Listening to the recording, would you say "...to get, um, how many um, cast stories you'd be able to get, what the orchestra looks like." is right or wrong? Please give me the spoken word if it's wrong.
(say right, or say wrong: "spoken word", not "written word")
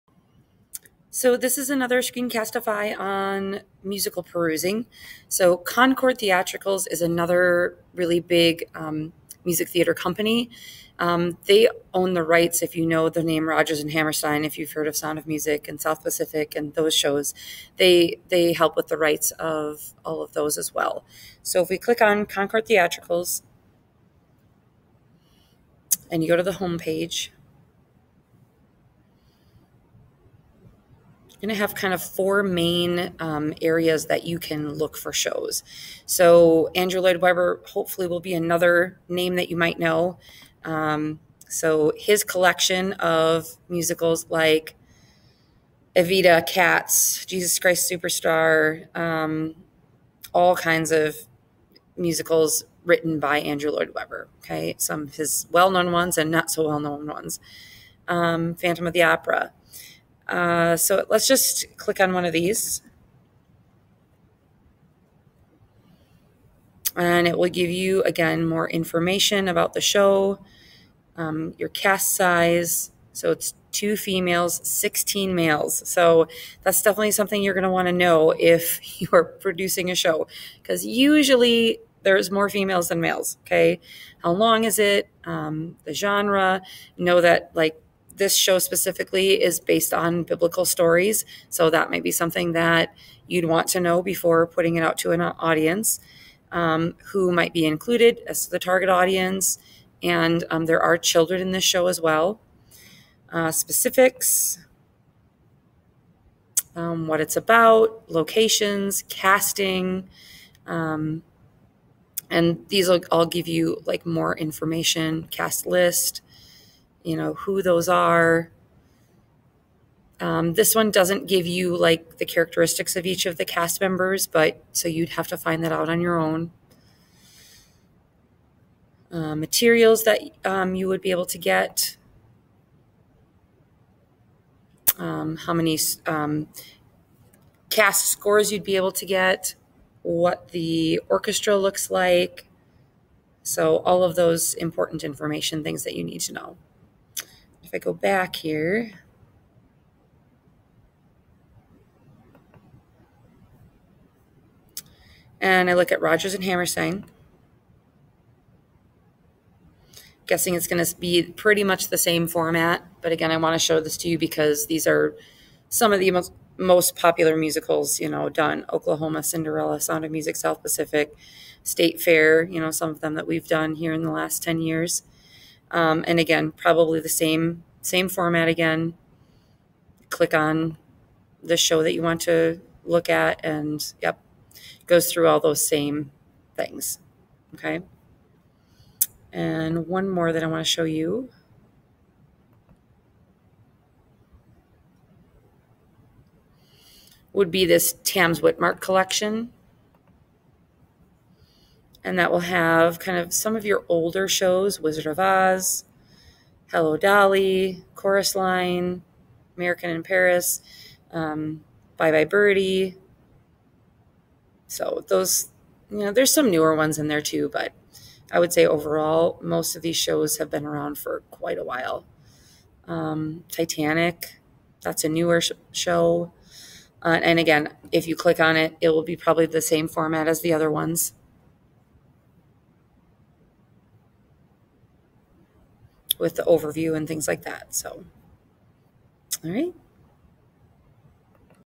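wrong: "scores", not "stories".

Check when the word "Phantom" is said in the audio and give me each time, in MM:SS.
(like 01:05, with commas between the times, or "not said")
00:58.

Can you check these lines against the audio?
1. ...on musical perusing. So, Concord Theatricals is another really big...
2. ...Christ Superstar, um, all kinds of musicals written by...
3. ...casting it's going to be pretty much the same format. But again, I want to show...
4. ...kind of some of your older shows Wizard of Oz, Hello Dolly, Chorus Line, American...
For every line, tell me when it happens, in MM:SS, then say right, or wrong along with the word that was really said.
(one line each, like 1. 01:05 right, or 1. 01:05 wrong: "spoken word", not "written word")
1. 00:02 right
2. 00:47 right
3. 02:40 wrong: "guessing", not "casting"
4. 03:22 right.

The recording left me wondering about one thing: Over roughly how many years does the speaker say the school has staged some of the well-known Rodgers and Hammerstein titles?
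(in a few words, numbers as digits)
10 years.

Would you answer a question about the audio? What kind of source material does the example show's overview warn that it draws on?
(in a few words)
biblical stories.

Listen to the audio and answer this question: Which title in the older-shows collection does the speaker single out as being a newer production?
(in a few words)
Titanic.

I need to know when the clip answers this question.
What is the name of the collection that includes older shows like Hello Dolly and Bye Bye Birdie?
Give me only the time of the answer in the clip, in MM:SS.
03:18.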